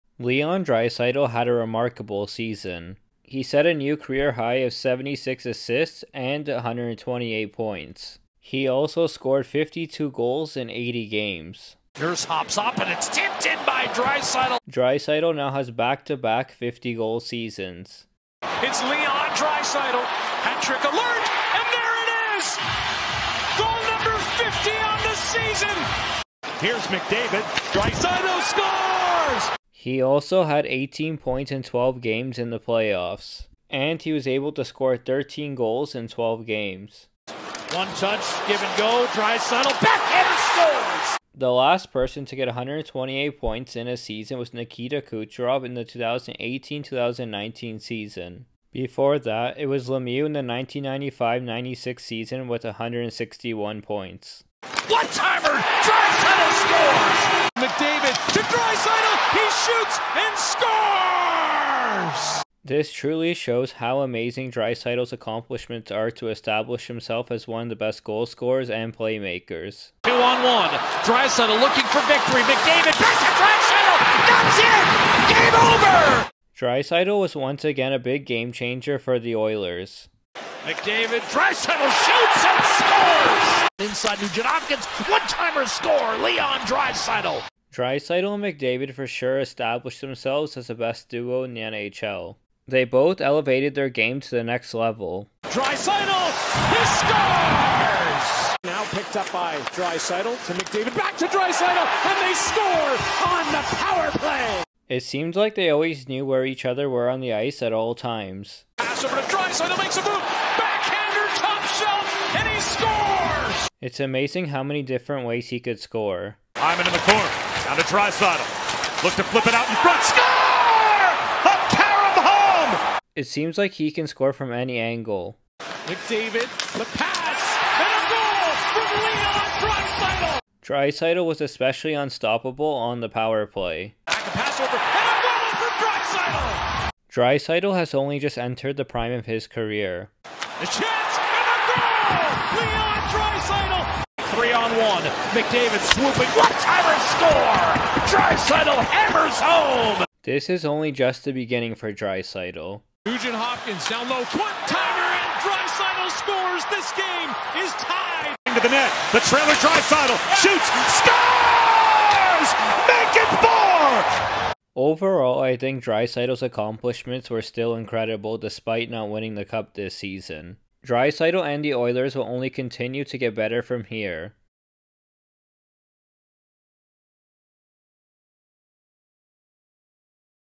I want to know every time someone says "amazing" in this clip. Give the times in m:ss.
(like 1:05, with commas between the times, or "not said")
1:03, 1:54.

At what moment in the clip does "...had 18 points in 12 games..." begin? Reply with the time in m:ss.
0:30.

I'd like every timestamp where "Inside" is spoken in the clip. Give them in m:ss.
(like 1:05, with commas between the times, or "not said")
1:23.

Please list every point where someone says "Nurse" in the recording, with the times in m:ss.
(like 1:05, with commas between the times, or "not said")
0:11.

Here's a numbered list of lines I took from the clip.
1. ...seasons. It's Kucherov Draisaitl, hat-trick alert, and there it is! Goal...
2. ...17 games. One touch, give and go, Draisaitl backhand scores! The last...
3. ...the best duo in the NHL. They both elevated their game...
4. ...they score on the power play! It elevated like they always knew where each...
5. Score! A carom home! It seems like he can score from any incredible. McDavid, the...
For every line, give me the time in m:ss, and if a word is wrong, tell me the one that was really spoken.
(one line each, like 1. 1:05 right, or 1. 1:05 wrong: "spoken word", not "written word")
1. 0:17 wrong: "Leon", not "Kucherov"
2. 0:36 wrong: "12", not "17"
3. 1:30 right
4. 1:42 wrong: "seemed", not "elevated"
5. 2:00 wrong: "angle", not "incredible".